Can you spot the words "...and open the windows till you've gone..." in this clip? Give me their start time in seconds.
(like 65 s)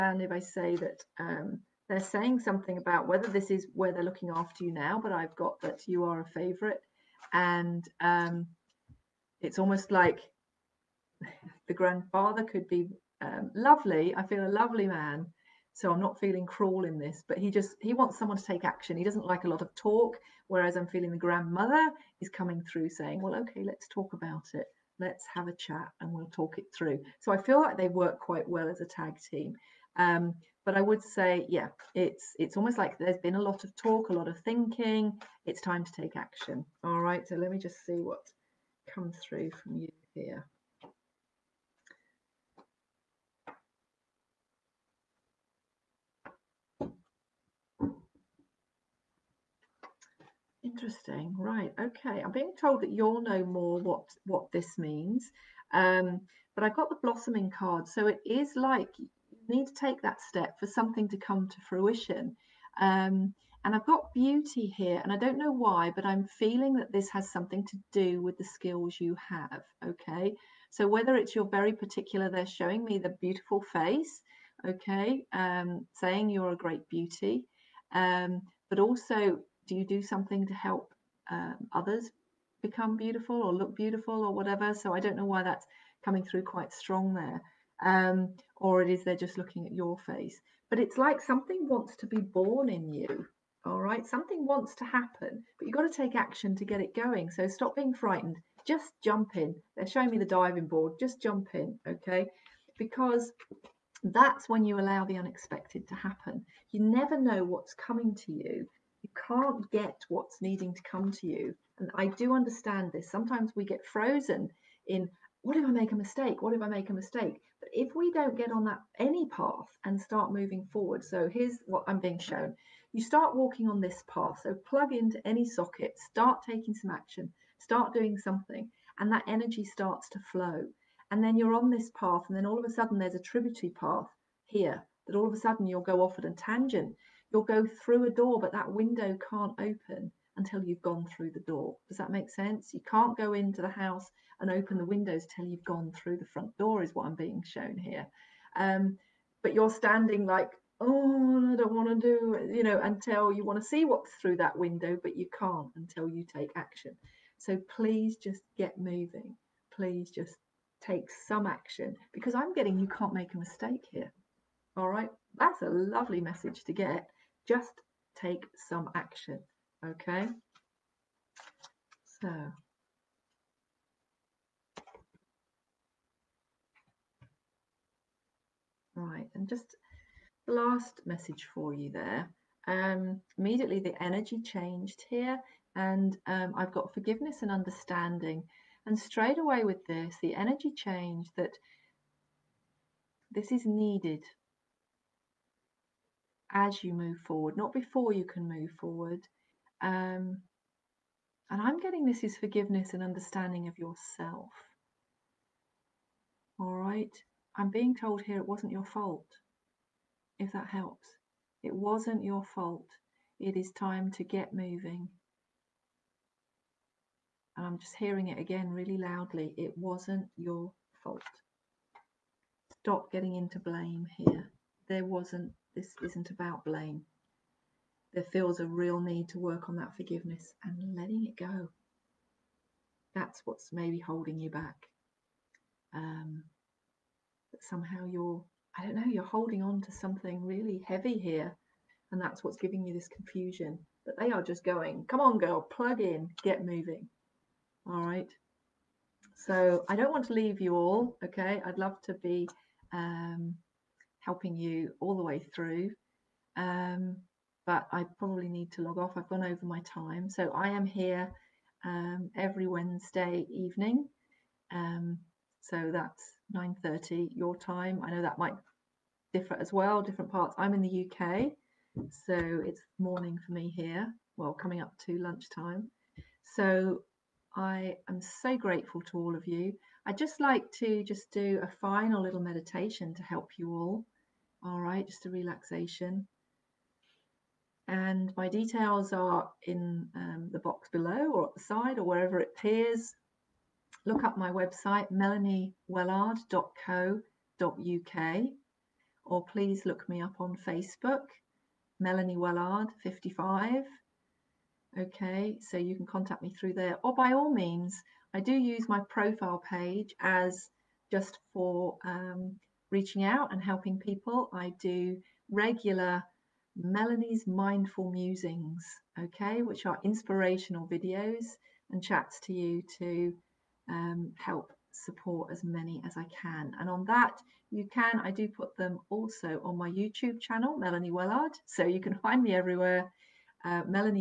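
144 s.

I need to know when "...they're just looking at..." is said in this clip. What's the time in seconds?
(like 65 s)
89 s.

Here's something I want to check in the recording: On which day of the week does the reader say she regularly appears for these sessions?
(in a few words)
Wednesday.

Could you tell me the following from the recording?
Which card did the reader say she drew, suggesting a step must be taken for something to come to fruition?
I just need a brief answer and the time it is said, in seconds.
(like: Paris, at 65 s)
Blossoming card, at 57 s.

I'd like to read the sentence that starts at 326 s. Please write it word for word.
And on that, you can, I do put them also on my YouTube channel, Melanie Wellard.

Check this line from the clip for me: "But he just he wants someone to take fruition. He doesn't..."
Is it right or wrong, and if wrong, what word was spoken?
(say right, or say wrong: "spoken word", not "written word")
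wrong: "action", not "fruition".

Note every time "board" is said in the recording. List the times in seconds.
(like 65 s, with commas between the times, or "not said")
100 s.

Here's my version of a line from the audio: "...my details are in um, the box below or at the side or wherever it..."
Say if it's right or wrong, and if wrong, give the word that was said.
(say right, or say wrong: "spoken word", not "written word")
right.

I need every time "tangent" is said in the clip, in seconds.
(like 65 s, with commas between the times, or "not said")
136 s.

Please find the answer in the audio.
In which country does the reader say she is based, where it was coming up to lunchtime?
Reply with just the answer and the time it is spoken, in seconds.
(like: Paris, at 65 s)
UK, at 271 s.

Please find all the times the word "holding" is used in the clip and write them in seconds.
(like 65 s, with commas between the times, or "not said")
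233 s, 239 s.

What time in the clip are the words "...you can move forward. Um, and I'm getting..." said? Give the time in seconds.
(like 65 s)
198 s.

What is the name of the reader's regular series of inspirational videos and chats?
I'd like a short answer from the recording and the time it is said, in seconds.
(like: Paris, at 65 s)
Melanie's Mindful Musings, at 316 s.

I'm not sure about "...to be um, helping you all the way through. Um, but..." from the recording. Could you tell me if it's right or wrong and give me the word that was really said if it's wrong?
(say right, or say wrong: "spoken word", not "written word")
right.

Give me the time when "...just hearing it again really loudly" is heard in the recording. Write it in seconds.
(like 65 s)
217 s.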